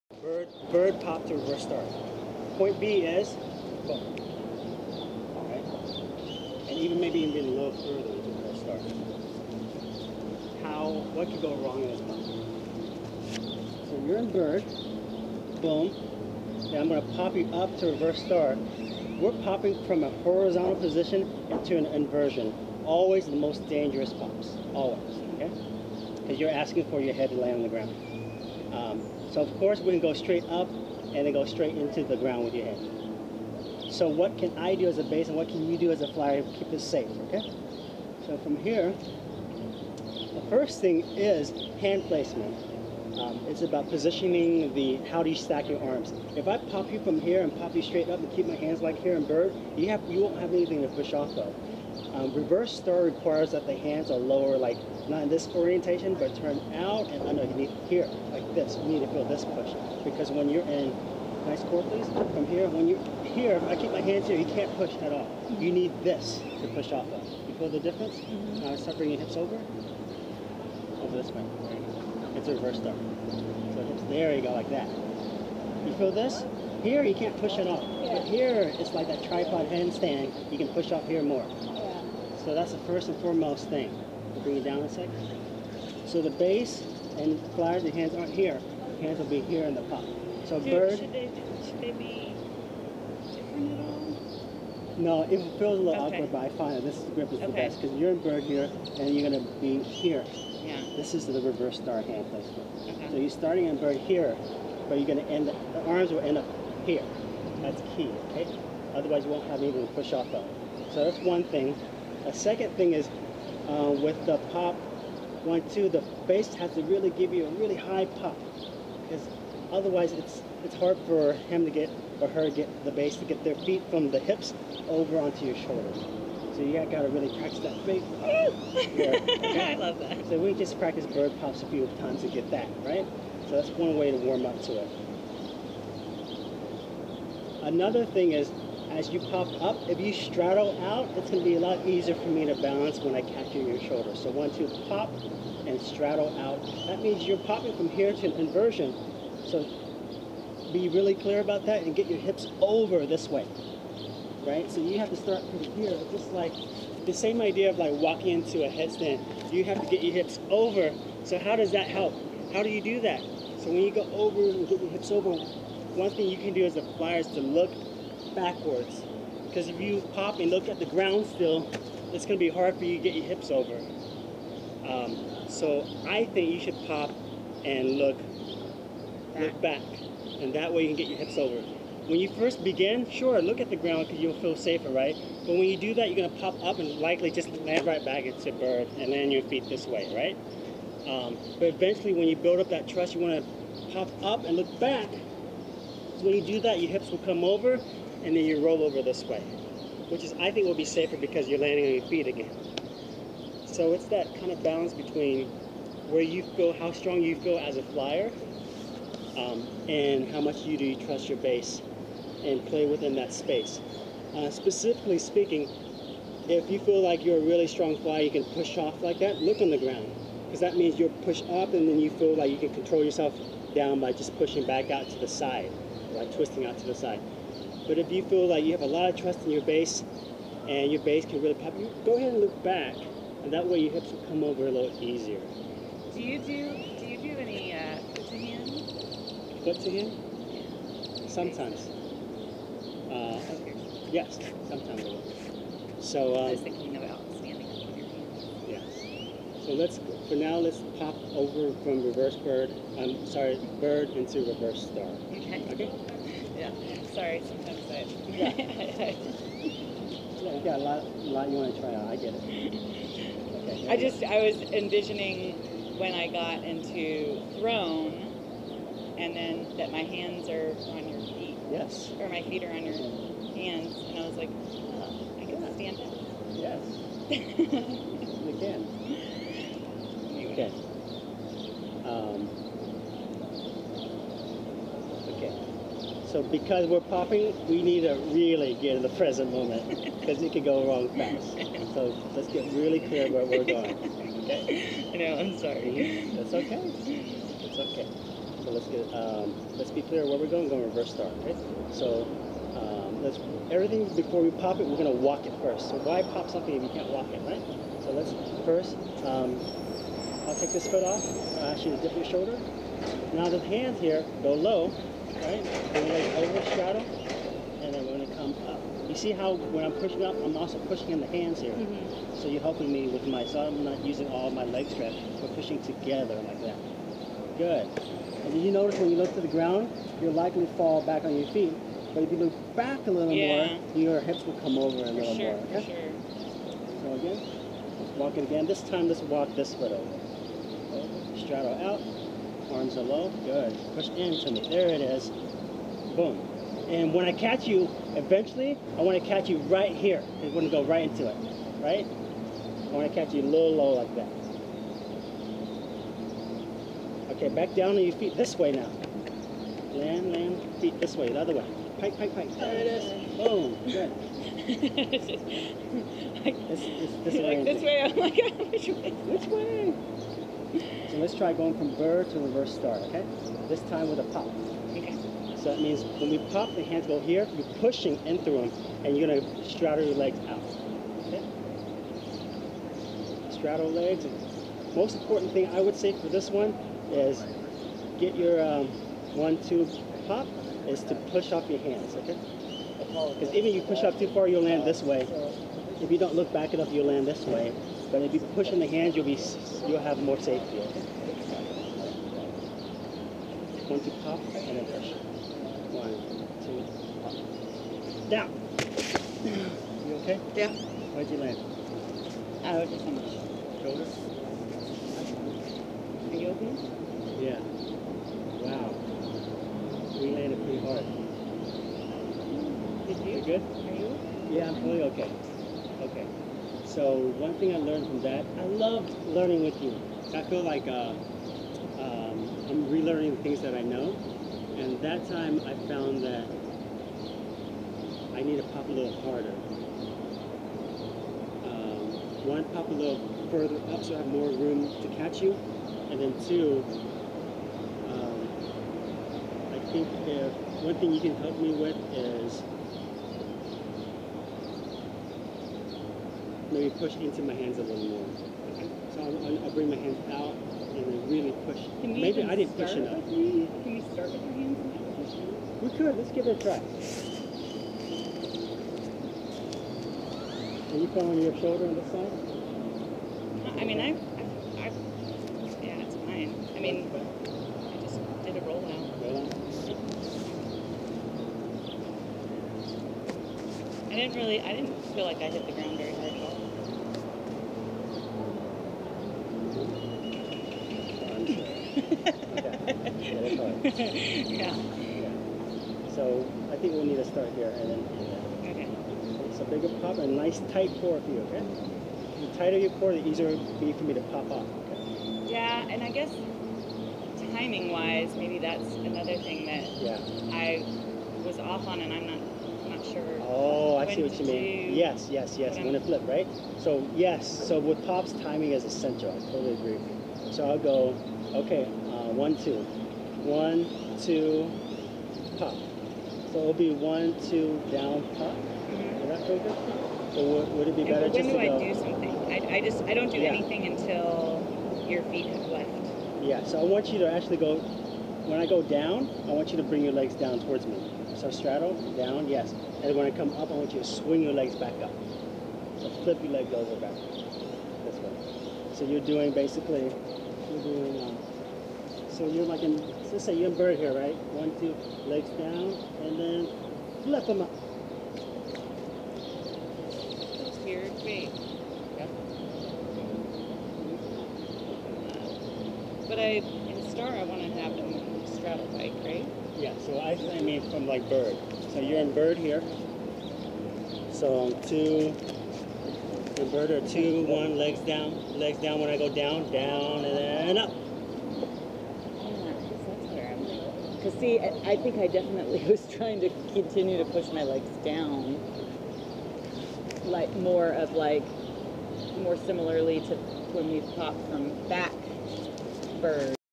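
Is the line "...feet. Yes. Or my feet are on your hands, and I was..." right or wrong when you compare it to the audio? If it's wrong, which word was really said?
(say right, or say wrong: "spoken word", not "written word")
right.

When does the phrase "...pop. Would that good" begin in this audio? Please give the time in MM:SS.
08:48.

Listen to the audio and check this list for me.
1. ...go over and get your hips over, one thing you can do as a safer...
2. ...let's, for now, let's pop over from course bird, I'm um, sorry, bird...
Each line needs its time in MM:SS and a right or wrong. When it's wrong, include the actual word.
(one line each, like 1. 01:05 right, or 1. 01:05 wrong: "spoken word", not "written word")
1. 02:43 wrong: "flyer", not "safer"
2. 04:09 wrong: "reverse", not "course".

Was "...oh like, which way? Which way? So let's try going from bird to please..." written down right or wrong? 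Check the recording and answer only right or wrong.
wrong.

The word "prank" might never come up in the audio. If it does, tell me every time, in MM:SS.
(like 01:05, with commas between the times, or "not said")
not said.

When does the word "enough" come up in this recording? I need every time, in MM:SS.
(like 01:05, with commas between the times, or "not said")
06:36, 07:42.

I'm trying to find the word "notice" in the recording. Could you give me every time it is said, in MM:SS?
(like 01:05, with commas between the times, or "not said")
05:28.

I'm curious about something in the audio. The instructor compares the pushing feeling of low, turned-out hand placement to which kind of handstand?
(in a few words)
Tripod handstand.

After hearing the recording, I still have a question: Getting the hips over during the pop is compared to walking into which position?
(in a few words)
A headstand.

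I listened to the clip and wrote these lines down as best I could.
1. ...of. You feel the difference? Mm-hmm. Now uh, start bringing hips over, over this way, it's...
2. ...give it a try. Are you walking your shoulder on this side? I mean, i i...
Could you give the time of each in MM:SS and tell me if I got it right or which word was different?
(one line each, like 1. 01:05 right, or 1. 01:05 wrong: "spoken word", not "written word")
1. 01:07 right
2. 07:46 wrong: "feeling", not "walking".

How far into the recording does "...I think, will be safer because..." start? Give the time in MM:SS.
03:20.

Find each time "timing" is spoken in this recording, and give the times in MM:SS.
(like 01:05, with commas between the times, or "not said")
08:27, 08:38.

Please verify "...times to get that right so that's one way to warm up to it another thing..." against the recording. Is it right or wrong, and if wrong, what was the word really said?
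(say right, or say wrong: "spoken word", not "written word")
right.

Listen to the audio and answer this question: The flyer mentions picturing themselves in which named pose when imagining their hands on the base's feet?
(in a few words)
Throne.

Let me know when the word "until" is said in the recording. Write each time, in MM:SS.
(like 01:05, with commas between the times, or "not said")
08:53.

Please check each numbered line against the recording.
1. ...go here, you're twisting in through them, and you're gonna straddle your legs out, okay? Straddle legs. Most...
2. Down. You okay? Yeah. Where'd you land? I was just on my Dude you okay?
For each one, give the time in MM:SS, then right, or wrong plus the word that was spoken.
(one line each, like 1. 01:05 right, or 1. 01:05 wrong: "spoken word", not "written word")
1. 06:17 wrong: "pushing", not "twisting"
2. 06:48 wrong: "Are", not "Dude".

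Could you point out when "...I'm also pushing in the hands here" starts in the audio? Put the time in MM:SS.
05:20.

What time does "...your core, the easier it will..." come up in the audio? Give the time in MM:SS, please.
08:22.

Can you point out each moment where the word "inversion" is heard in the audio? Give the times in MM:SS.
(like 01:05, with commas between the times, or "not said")
00:21, 02:28.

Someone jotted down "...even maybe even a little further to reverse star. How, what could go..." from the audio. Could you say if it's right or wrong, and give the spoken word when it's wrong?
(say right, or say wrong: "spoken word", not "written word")
right.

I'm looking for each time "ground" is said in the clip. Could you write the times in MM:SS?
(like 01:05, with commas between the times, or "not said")
00:27, 00:32, 02:50, 03:03, 03:39, 05:29, 08:05.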